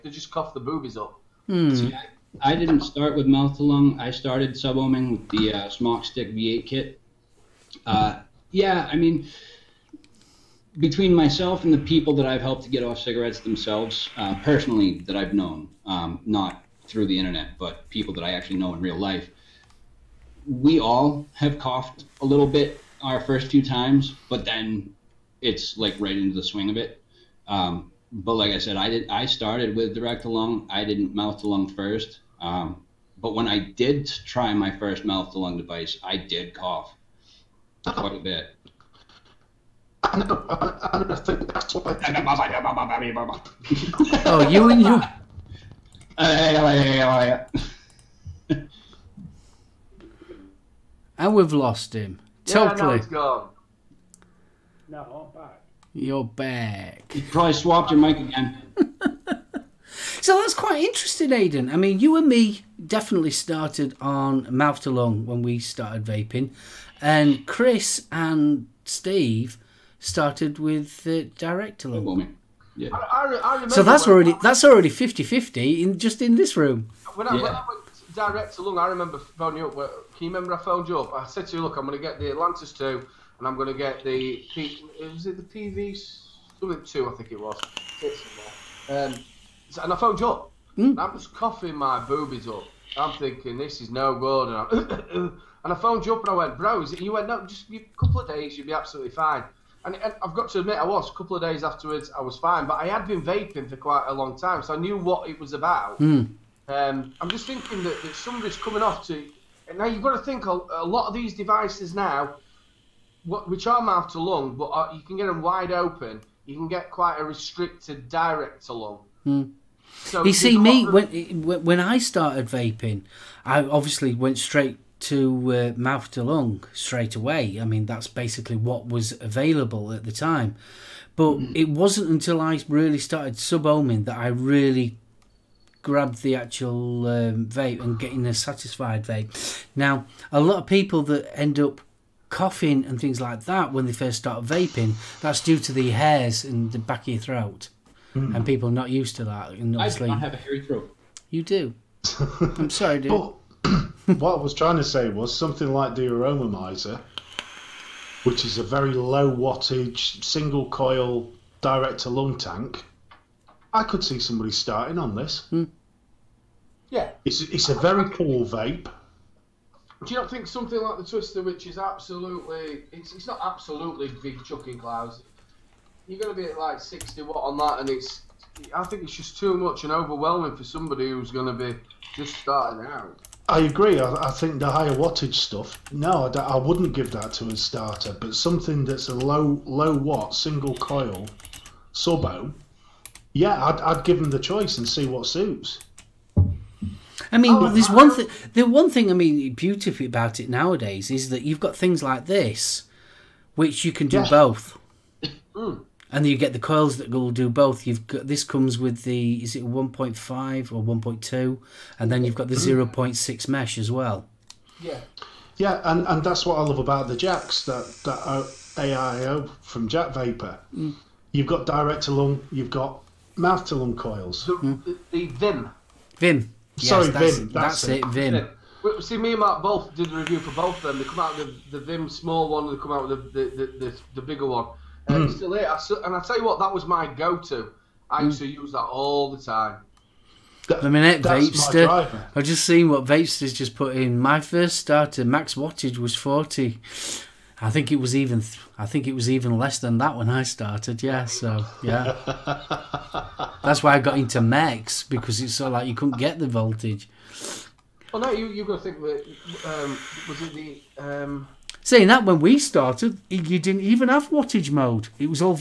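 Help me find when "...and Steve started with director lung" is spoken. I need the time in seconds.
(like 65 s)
68 s.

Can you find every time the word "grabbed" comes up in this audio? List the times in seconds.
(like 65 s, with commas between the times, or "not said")
135 s.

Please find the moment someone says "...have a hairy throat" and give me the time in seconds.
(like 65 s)
150 s.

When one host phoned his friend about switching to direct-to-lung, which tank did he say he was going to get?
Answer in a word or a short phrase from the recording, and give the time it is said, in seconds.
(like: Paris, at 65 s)
Atlantis 2, at 82 s.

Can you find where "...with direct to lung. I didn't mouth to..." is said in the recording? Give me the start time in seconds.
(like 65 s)
29 s.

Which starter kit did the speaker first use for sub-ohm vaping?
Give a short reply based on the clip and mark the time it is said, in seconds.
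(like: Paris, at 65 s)
Smok Stick V8, at 5 s.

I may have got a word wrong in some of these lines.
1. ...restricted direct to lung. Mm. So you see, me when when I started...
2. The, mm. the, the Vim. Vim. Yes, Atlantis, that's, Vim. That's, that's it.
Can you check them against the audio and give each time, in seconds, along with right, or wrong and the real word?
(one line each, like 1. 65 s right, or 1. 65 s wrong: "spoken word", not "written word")
1. 117 s right
2. 224 s wrong: "Sorry", not "Atlantis".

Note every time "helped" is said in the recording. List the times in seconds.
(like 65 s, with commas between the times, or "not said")
12 s.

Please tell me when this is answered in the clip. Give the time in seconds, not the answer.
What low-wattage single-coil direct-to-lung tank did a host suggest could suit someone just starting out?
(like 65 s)
156 s.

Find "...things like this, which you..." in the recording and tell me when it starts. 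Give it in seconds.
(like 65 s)
201 s.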